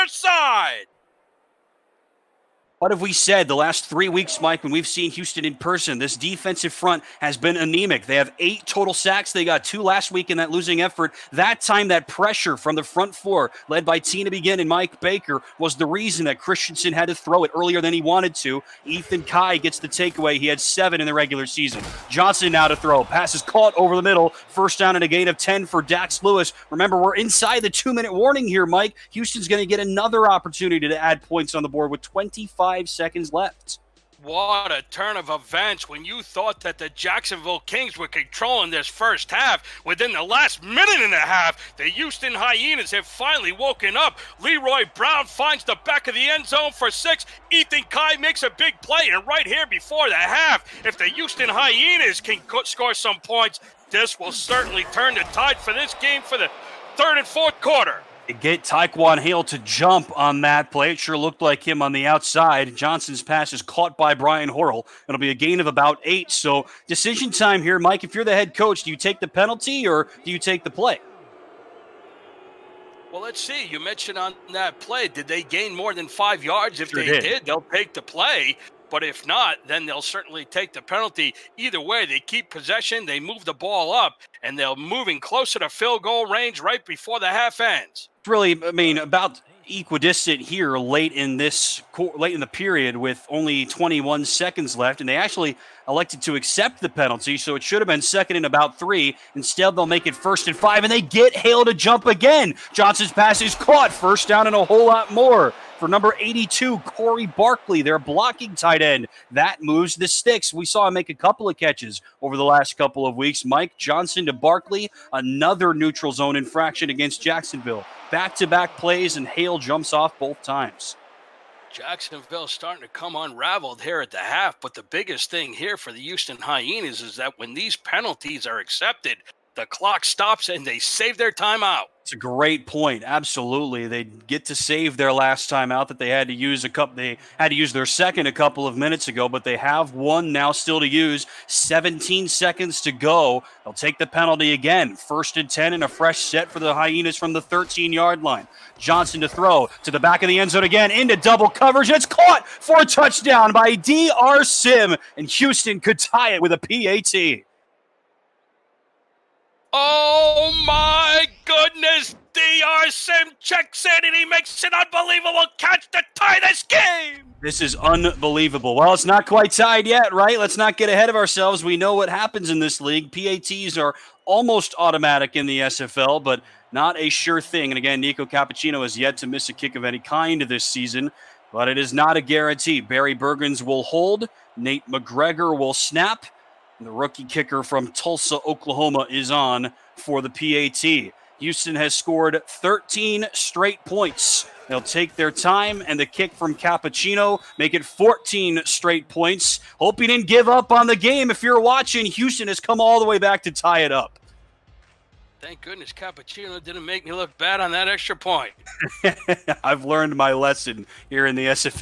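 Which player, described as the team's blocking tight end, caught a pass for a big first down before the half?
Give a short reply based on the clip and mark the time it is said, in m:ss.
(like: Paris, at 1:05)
Corey Barkley, at 1:46.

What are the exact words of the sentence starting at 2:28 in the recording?
Johnson to throw to the back of the end zone again into double coverage.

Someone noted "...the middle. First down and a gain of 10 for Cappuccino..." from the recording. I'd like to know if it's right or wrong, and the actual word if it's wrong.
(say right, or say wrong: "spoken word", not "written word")
wrong: "Dax", not "Cappuccino".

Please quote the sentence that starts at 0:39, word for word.
Within the last minute and a half, the Houston Hyenas have finally woken up.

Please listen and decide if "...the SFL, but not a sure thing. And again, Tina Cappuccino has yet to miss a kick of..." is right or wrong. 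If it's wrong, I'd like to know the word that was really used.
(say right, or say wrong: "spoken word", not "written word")
wrong: "Nico", not "Tina".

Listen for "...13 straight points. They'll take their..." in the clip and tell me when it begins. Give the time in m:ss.
3:12.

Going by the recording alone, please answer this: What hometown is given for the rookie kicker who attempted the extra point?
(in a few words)
Tulsa, Oklahoma.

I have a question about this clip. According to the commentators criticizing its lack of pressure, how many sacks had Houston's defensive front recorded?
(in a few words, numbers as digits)
8.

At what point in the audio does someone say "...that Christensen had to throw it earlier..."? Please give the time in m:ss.
0:16.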